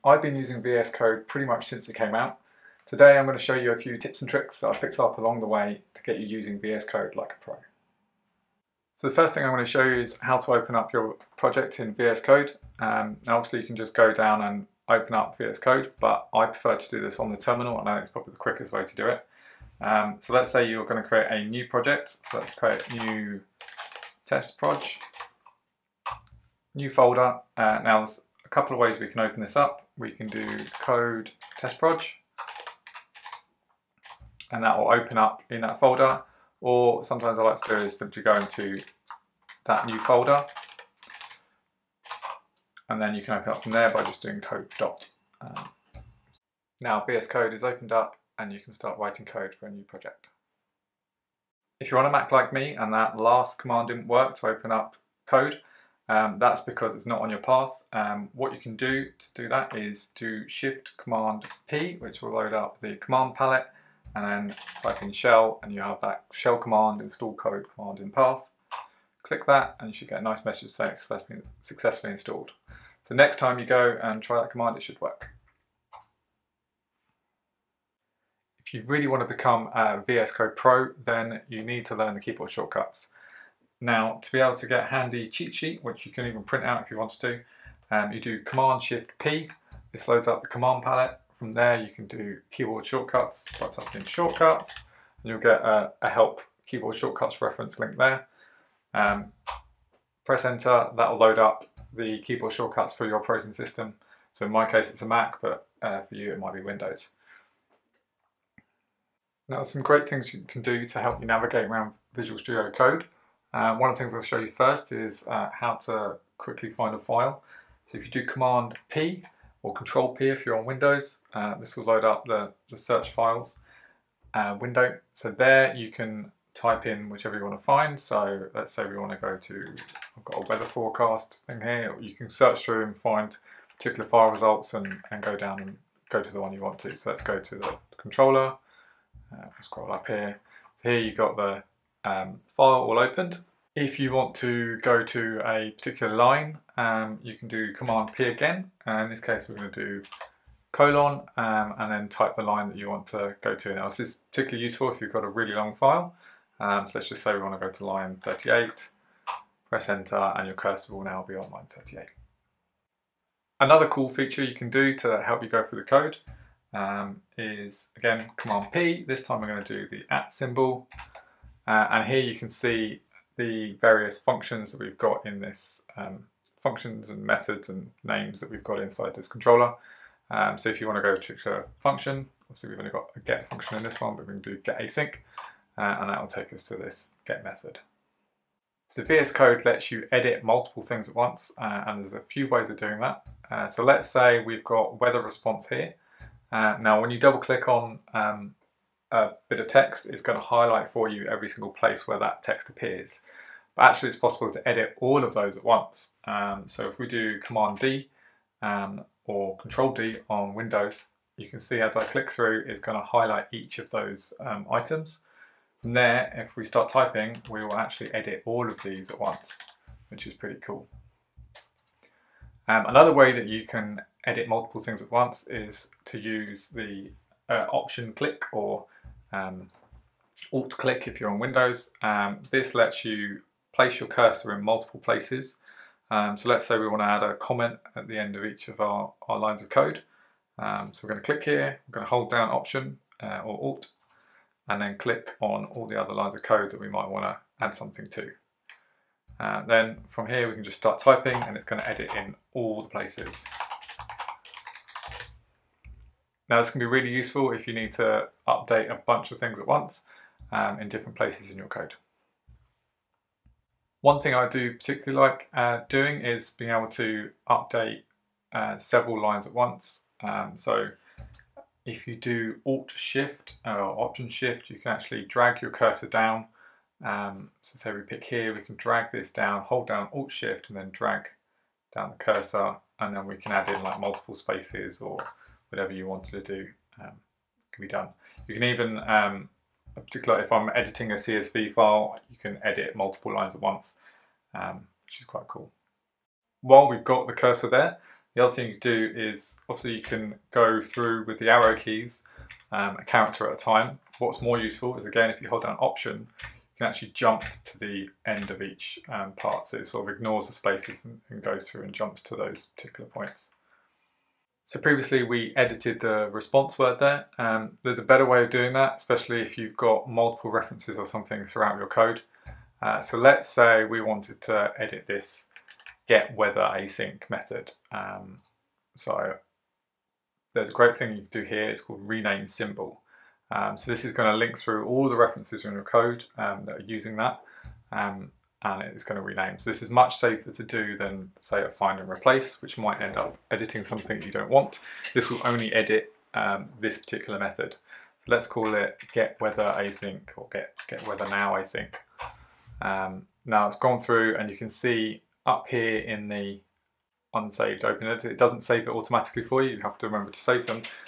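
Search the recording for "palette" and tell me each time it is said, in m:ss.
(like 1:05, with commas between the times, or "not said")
1:03, 1:30.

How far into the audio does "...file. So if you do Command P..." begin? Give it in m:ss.
1:56.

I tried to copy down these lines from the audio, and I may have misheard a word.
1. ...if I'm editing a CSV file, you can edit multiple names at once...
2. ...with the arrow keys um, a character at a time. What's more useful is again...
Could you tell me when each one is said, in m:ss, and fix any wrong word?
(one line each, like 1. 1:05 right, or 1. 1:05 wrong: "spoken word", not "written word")
1. 4:50 wrong: "lines", not "names"
2. 5:01 right.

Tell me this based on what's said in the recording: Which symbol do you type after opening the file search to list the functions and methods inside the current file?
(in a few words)
at symbol.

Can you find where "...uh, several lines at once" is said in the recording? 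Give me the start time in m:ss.
4:28.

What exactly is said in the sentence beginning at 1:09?
Click that, and you should get a nice message saying successfully, successfully installed.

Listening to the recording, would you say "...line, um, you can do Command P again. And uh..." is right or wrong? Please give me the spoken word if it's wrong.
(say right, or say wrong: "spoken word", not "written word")
right.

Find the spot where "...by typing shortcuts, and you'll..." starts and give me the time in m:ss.
1:33.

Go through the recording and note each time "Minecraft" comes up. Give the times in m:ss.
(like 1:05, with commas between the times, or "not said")
not said.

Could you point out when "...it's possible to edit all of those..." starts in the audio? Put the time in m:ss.
3:24.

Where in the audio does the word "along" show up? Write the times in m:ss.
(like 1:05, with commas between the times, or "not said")
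0:05.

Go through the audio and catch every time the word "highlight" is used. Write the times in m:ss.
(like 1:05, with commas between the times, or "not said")
3:20, 3:33.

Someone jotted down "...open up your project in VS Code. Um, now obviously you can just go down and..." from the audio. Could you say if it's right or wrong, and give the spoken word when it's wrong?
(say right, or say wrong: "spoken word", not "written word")
right.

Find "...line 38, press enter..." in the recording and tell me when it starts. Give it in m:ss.
2:37.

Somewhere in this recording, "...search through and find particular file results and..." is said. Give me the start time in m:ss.
2:12.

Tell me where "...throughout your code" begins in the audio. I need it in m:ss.
5:21.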